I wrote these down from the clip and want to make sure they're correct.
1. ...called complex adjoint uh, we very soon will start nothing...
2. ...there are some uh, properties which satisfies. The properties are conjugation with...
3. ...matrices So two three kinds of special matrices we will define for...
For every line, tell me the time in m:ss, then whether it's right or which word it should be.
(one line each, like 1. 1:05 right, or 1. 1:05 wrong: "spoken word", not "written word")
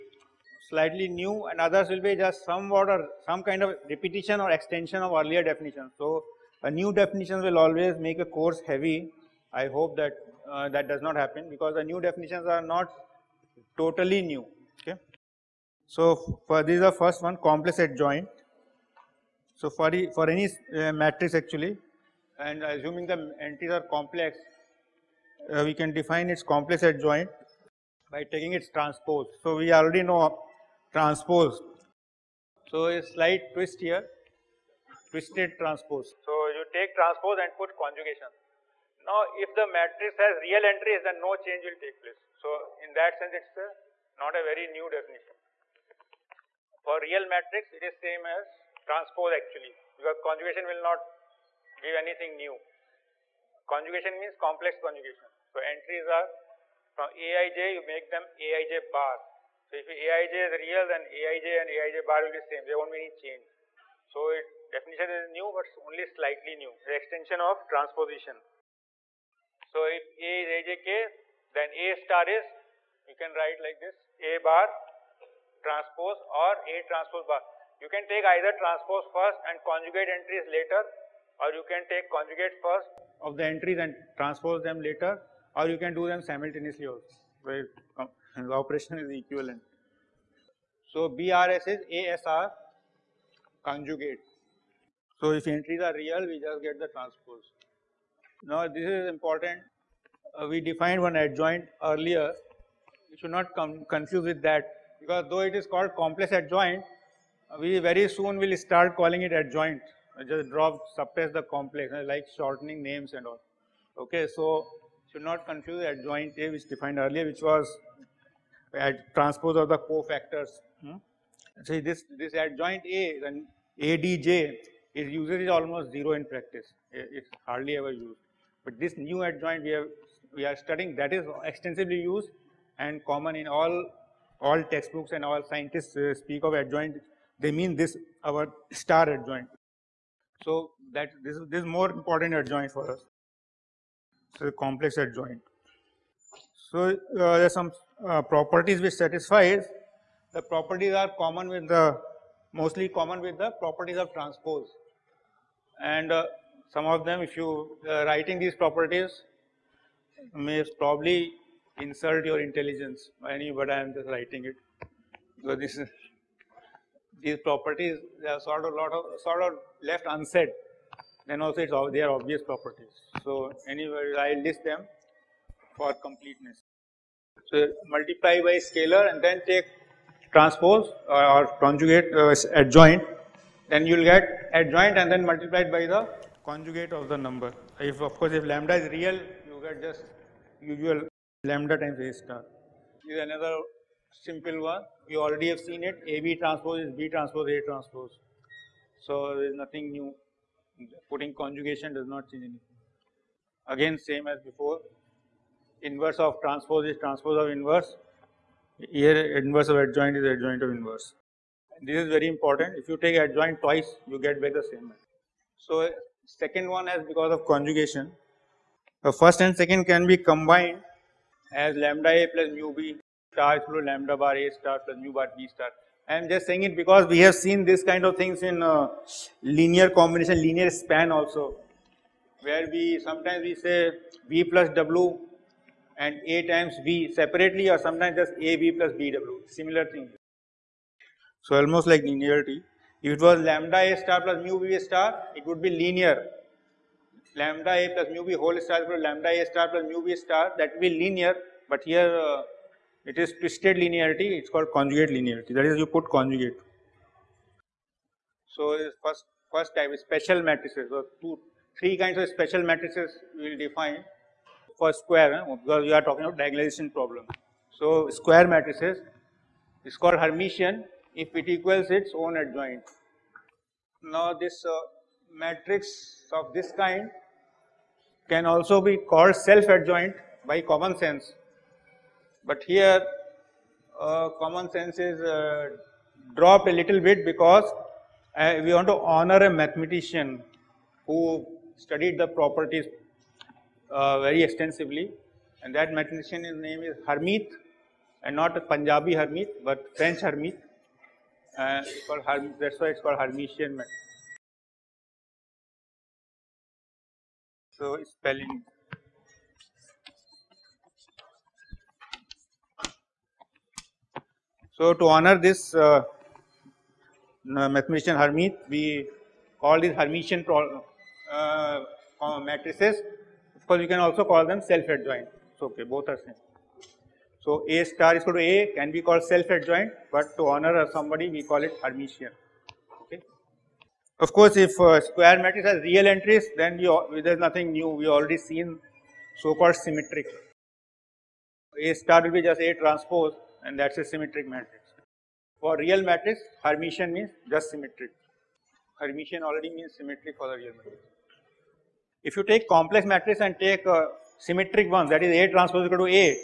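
1. 1:45 wrong: "calling", not "nothing"
2. 2:27 wrong: "common", not "conjugation"
3. 4:20 right.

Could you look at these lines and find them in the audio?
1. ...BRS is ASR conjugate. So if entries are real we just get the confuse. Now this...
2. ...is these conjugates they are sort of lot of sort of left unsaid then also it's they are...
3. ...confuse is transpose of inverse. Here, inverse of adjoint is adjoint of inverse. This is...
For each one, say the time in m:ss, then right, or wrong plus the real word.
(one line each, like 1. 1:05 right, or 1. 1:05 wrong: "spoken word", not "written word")
1. 1:31 wrong: "transpose", not "confuse"
2. 2:45 wrong: "properties", not "conjugates"
3. 3:26 wrong: "transpose", not "confuse".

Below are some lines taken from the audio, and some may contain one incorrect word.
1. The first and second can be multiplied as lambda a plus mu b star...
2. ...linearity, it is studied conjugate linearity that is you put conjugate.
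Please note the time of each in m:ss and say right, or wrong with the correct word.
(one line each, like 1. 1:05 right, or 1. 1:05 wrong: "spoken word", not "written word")
1. 3:39 wrong: "combined", not "multiplied"
2. 4:13 wrong: "called", not "studied".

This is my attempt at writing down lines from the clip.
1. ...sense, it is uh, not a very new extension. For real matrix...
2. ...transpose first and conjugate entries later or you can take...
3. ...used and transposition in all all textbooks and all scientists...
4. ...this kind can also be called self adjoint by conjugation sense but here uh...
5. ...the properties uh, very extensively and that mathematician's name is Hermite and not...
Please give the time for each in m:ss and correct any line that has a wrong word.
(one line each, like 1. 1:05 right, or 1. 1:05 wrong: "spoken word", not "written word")
1. 0:43 wrong: "definition", not "extension"
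2. 1:18 right
3. 2:12 wrong: "common", not "transposition"
4. 4:36 wrong: "common", not "conjugation"
5. 4:52 right.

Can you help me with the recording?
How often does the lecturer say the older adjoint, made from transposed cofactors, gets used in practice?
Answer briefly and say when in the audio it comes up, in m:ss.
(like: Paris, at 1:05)
almost zero, at 2:05.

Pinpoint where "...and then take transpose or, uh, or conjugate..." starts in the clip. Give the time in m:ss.
2:59.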